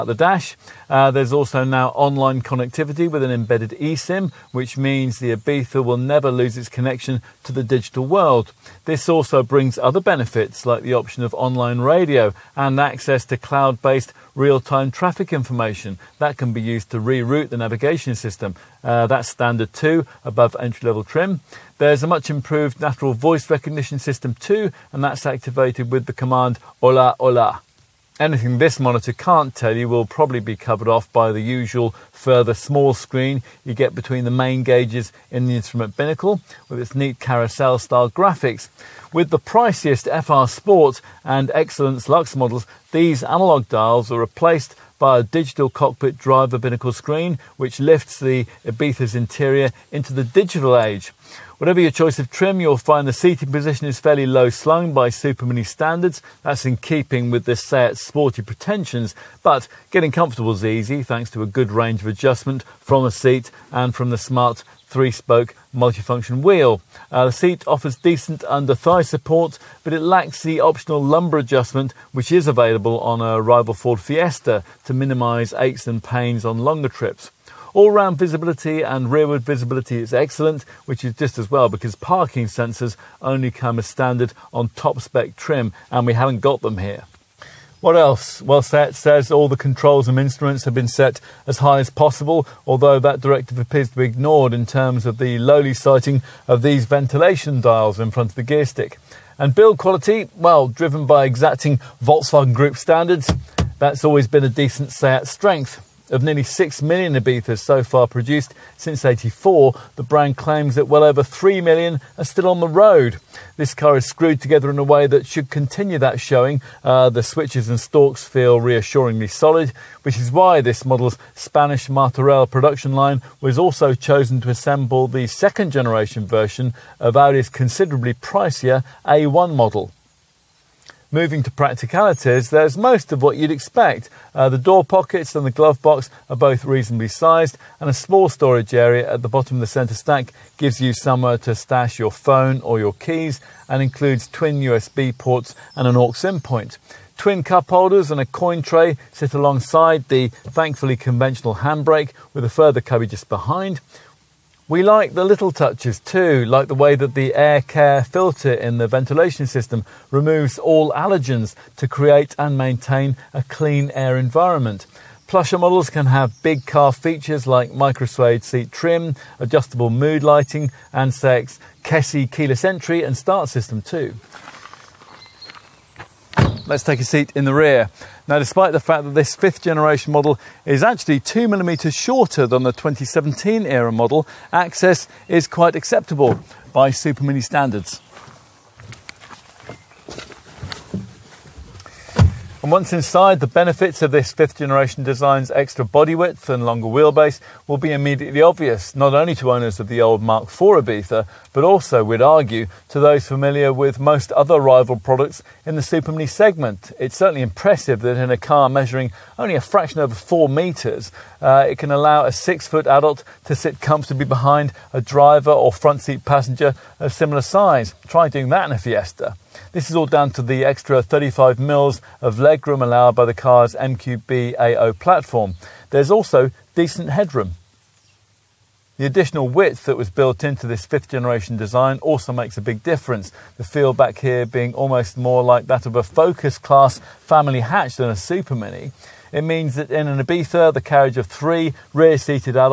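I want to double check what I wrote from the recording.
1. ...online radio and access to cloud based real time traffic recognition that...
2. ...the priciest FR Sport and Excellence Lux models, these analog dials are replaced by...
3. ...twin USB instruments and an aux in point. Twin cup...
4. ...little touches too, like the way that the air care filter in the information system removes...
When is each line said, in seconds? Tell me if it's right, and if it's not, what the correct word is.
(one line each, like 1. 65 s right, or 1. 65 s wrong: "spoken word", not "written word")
1. 11 s wrong: "information", not "recognition"
2. 39 s right
3. 144 s wrong: "ports", not "instruments"
4. 155 s wrong: "ventilation", not "information".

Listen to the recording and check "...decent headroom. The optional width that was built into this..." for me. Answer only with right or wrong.
wrong.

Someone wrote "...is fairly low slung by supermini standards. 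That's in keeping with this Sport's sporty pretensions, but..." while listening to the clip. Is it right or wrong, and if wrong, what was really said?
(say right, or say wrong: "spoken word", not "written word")
wrong: "Seat", not "Sport".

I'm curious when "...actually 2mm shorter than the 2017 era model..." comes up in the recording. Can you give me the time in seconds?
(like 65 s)
180 s.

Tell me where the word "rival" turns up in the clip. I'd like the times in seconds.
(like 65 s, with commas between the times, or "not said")
73 s, 204 s.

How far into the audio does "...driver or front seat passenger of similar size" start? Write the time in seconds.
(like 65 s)
215 s.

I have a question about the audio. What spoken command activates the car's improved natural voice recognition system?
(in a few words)
Hola Hola.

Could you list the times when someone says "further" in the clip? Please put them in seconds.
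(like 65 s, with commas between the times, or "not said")
32 s, 152 s.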